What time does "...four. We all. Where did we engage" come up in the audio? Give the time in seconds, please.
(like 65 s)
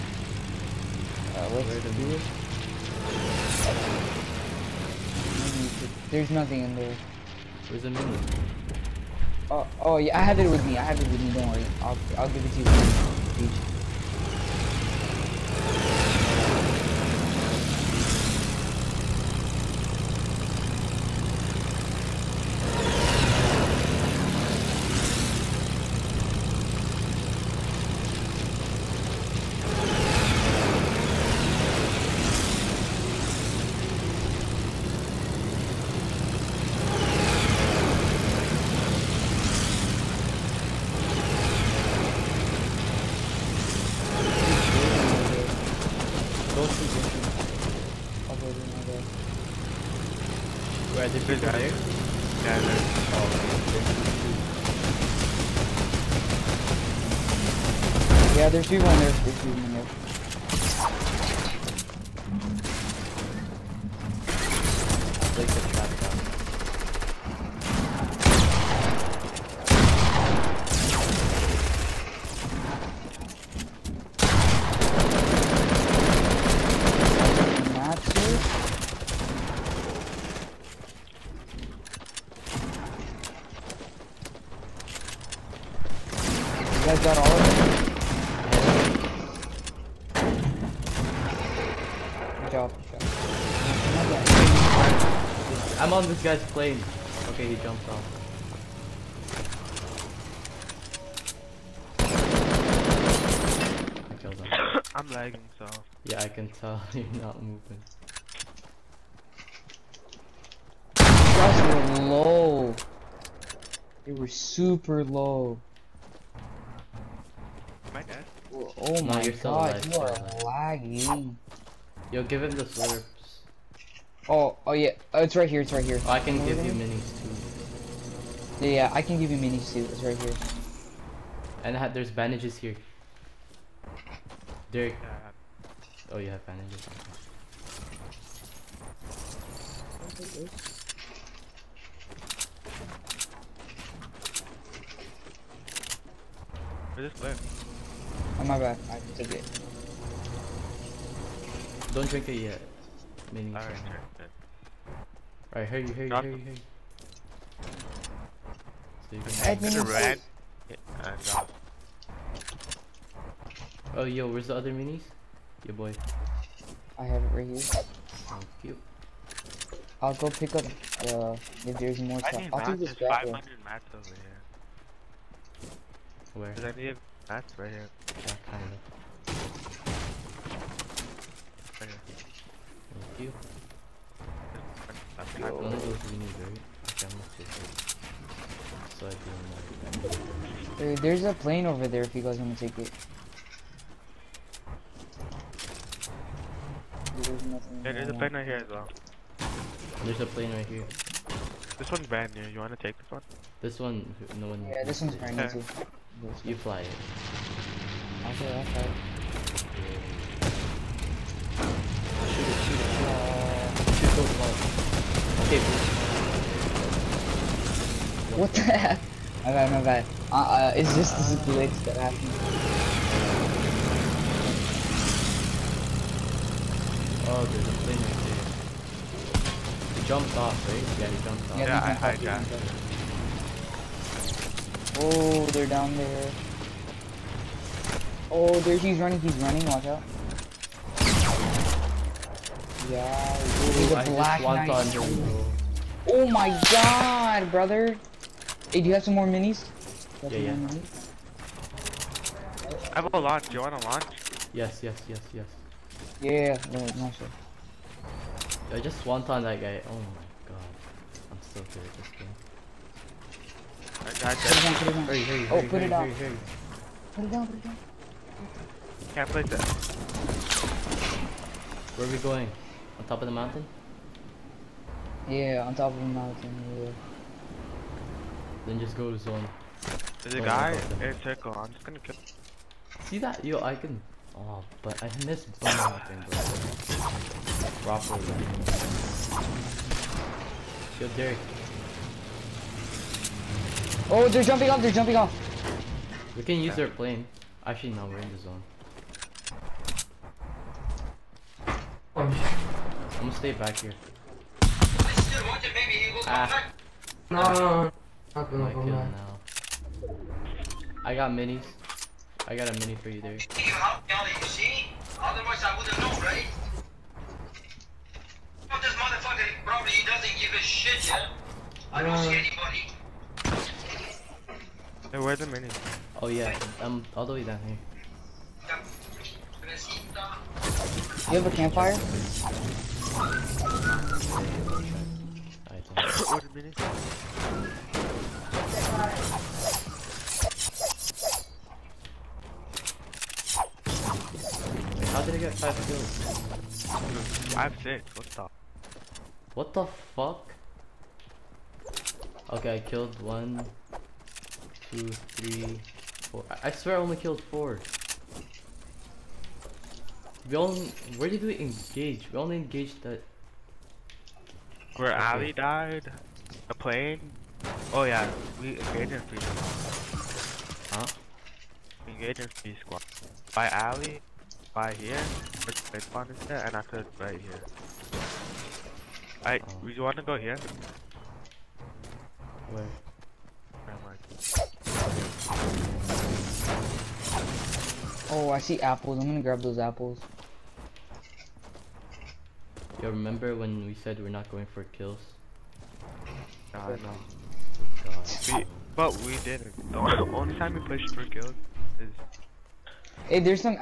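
357 s.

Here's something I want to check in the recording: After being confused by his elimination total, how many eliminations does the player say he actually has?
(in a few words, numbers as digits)
6.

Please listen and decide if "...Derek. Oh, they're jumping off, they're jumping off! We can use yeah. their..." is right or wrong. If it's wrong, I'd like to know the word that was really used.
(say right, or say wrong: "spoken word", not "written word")
right.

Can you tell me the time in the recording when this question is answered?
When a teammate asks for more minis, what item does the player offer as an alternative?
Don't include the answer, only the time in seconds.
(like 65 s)
253 s.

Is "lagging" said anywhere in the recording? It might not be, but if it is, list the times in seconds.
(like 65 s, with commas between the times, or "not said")
105 s, 120 s.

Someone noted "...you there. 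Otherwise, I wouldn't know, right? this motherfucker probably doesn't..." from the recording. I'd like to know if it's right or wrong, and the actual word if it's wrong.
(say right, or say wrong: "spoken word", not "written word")
right.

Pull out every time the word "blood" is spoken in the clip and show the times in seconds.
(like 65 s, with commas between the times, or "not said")
not said.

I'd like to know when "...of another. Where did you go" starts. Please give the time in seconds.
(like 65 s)
48 s.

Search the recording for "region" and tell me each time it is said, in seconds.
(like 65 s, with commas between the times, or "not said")
not said.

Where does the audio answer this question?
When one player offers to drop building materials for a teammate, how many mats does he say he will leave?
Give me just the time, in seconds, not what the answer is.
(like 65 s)
173 s.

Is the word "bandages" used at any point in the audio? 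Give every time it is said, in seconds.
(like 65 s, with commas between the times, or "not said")
132 s, 136 s.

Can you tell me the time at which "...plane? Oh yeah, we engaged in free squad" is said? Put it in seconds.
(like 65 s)
366 s.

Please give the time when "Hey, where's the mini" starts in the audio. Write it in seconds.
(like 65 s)
325 s.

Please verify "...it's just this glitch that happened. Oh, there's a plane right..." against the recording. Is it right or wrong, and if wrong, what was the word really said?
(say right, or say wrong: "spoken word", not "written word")
right.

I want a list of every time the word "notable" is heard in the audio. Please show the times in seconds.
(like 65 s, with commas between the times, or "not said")
not said.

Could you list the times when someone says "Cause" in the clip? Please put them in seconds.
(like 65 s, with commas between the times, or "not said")
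176 s.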